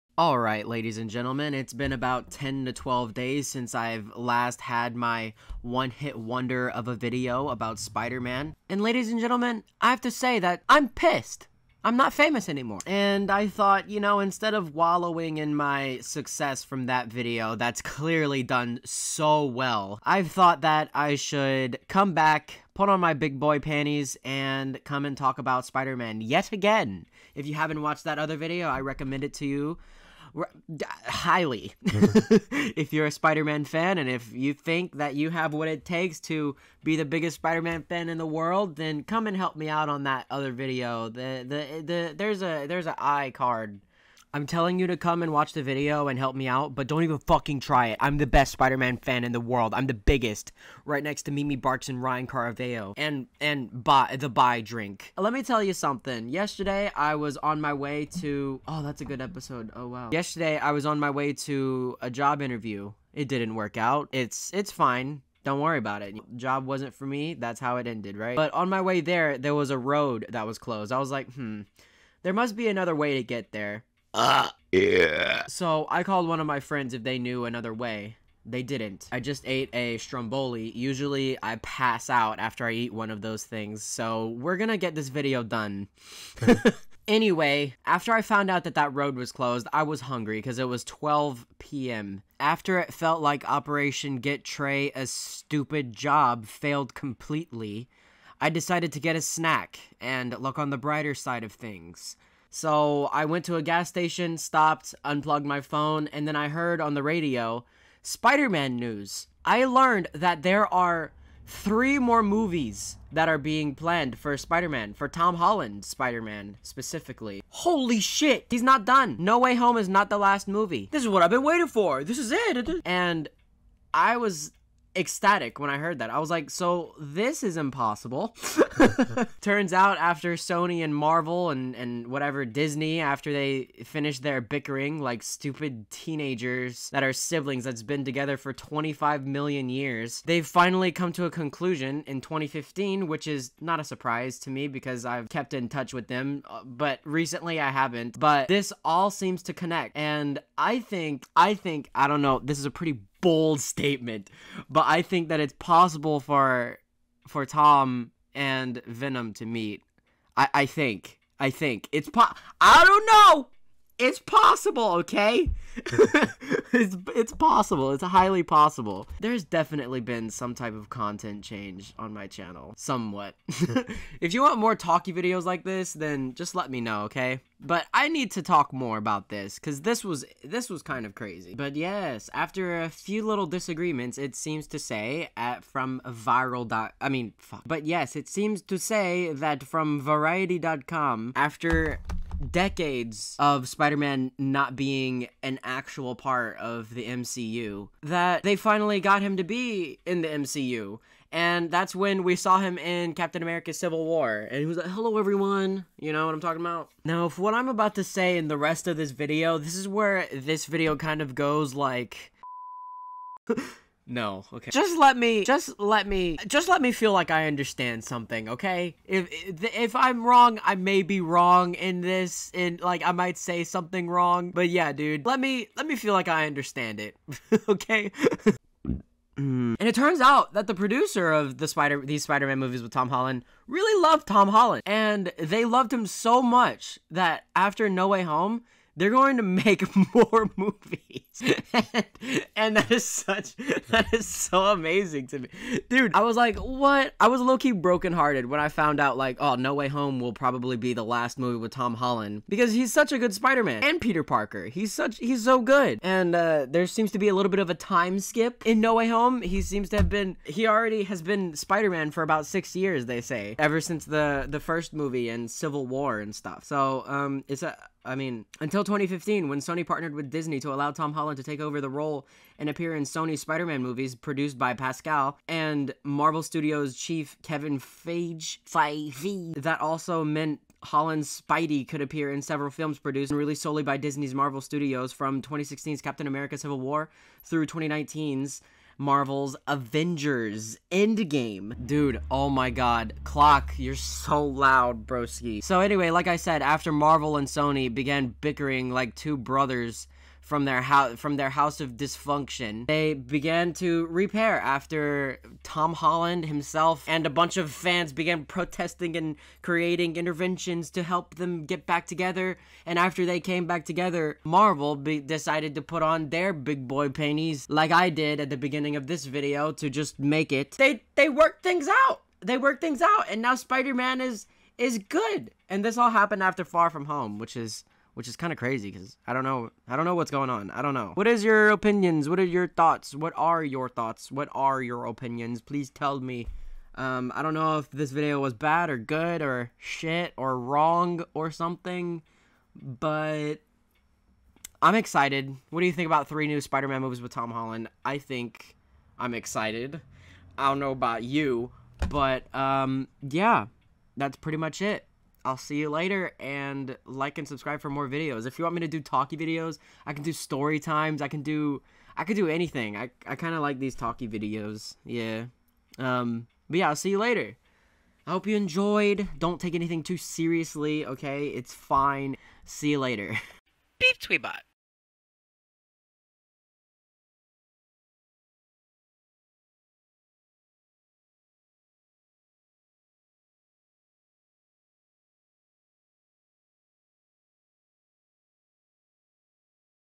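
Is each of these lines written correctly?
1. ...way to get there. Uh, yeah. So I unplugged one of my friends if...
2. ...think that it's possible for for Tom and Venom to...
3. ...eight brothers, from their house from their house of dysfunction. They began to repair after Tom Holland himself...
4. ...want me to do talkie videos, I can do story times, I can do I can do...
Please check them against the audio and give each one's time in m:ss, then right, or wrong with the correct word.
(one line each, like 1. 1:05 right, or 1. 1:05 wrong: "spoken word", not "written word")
1. 1:12 wrong: "called", not "unplugged"
2. 2:35 right
3. 4:59 wrong: "two", not "eight"
4. 5:58 right.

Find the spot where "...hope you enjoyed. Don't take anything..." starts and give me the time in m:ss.
6:08.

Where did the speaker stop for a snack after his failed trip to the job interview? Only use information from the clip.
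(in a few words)
gas station.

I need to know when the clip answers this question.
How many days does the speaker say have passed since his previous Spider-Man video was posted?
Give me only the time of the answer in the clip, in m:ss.
0:02.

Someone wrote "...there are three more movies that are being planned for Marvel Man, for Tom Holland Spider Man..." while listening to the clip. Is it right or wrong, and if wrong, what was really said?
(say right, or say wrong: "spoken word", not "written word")
wrong: "Spider", not "Marvel".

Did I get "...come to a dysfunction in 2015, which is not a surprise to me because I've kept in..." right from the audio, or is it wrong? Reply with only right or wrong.
wrong.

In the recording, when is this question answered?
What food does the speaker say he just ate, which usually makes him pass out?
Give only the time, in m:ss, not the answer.
1:19.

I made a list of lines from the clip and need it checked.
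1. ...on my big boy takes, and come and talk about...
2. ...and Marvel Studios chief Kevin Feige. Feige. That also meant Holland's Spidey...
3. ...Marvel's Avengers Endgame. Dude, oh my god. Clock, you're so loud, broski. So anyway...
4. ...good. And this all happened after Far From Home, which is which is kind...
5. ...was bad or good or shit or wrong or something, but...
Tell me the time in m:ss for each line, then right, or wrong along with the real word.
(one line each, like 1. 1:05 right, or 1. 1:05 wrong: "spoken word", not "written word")
1. 0:22 wrong: "panties", not "takes"
2. 4:35 right
3. 4:49 right
4. 5:24 right
5. 5:38 right.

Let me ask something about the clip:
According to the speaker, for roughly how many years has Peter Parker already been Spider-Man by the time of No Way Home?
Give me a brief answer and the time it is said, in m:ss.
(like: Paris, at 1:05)
6, at 4:22.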